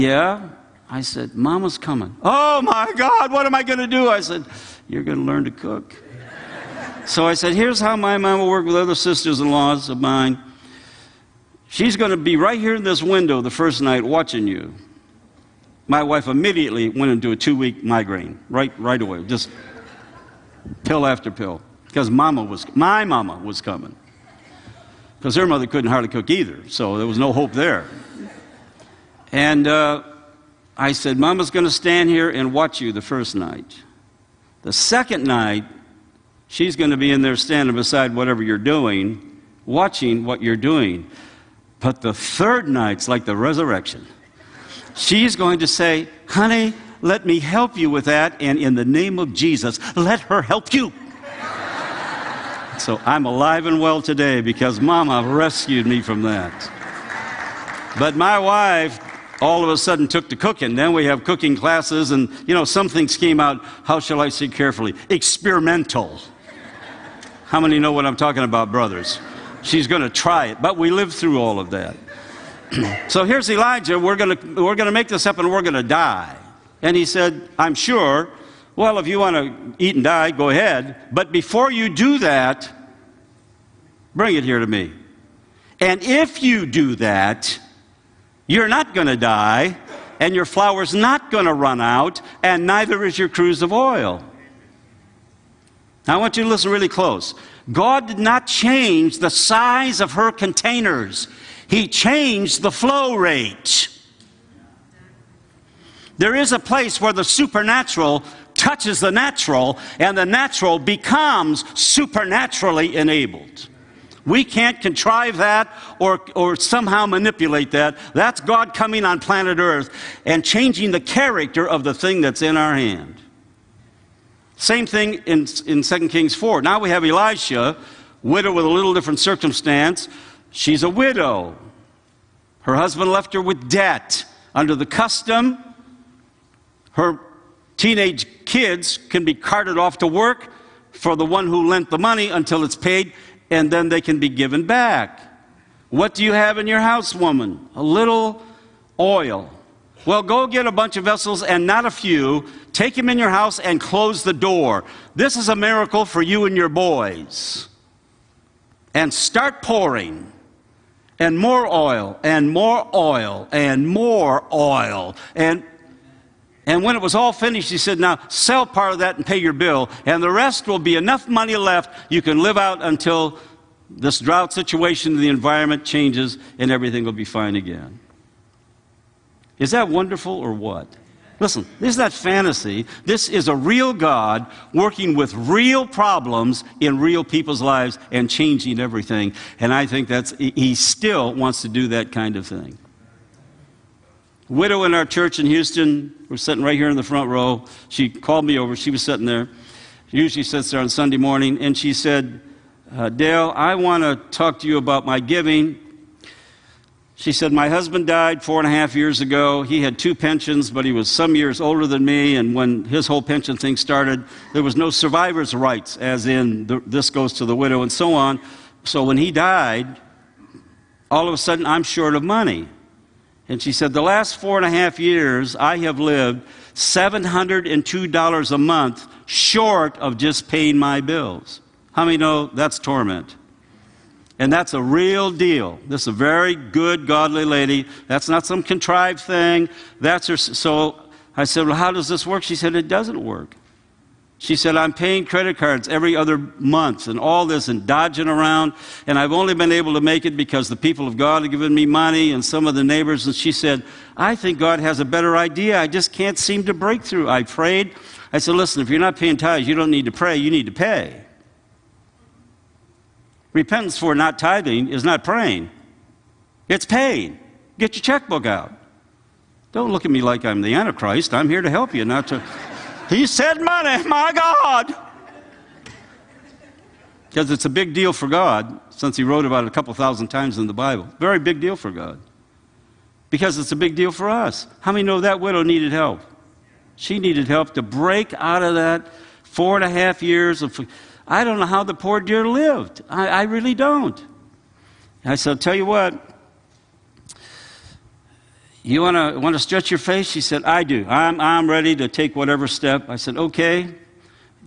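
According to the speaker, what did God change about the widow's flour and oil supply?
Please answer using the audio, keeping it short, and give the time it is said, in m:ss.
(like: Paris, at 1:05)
flow rate, at 1:42.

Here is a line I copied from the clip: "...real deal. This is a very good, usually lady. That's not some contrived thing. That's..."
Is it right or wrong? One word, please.
wrong.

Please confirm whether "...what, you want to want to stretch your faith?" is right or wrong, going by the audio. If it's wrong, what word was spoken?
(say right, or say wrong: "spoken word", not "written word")
right.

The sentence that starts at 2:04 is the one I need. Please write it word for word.
Same thing in, in 2 Kings 4.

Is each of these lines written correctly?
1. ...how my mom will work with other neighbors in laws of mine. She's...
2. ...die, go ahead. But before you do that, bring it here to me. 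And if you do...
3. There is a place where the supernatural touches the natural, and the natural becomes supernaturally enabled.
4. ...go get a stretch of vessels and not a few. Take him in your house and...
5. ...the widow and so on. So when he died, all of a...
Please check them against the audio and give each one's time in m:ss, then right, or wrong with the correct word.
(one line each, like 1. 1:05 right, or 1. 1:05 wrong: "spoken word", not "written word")
1. 0:07 wrong: "sisters", not "neighbors"
2. 1:20 right
3. 1:46 right
4. 2:30 wrong: "bunch", not "stretch"
5. 3:37 right.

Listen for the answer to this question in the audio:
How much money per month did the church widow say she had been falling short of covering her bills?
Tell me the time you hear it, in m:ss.
3:46.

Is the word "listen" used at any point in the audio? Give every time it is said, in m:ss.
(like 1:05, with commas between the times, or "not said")
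1:36, 3:01, 4:18.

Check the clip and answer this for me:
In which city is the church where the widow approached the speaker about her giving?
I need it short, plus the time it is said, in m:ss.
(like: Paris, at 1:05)
Houston, at 3:15.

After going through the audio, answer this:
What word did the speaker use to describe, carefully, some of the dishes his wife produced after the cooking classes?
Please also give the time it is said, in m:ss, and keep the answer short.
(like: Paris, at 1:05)
Experimental, at 1:05.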